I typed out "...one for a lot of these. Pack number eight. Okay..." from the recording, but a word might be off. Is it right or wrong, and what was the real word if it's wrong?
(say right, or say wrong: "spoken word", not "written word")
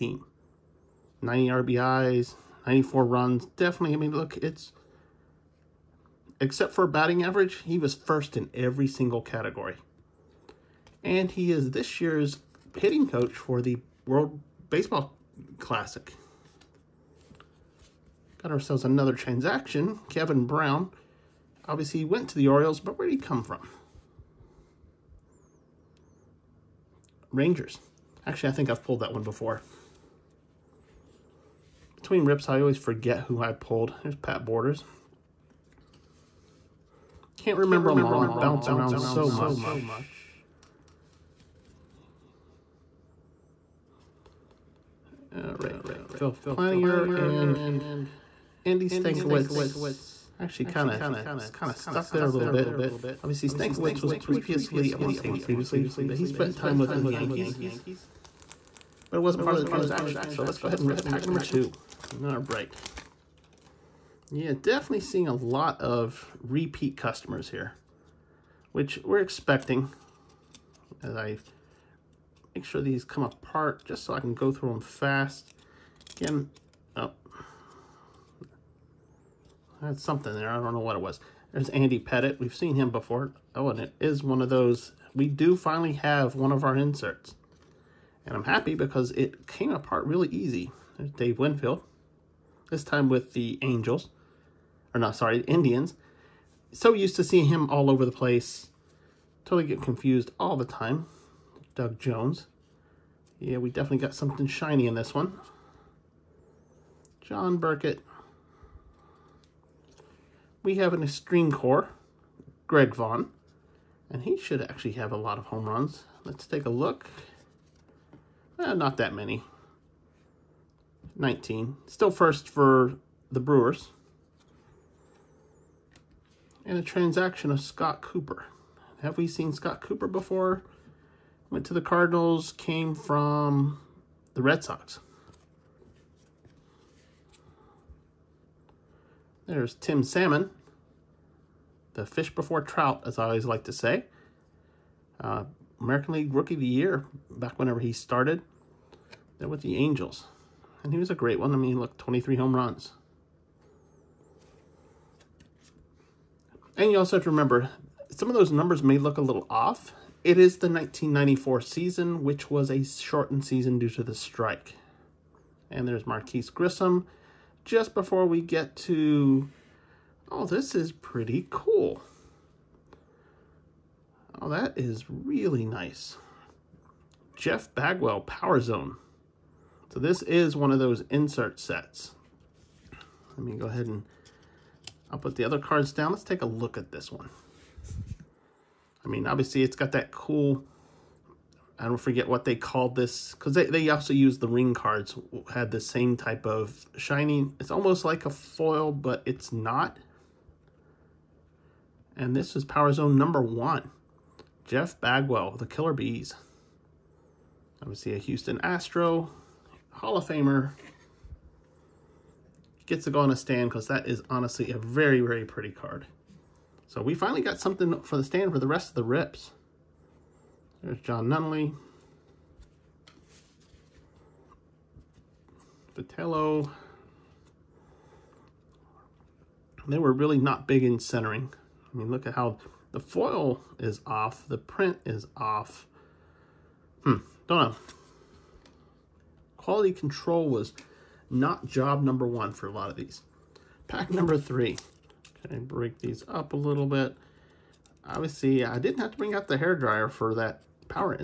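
wrong: "three", not "eight".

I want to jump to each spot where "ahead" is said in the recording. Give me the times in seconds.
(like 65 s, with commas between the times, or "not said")
60 s, 183 s.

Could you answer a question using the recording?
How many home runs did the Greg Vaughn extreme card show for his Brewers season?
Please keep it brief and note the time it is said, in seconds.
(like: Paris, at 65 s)
19, at 121 s.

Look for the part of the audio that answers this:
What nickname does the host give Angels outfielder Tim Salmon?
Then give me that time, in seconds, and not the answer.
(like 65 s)
141 s.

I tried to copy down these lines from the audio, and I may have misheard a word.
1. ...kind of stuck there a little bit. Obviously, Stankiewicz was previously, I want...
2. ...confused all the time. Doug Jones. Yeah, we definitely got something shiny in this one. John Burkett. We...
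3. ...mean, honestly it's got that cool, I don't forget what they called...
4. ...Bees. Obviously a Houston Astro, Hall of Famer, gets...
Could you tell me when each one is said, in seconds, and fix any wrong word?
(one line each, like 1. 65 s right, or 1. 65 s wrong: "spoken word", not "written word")
1. 51 s right
2. 99 s right
3. 189 s wrong: "obviously", not "honestly"
4. 205 s right.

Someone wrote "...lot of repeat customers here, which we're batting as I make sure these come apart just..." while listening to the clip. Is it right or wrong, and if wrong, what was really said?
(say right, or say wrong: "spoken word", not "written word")
wrong: "expecting", not "batting".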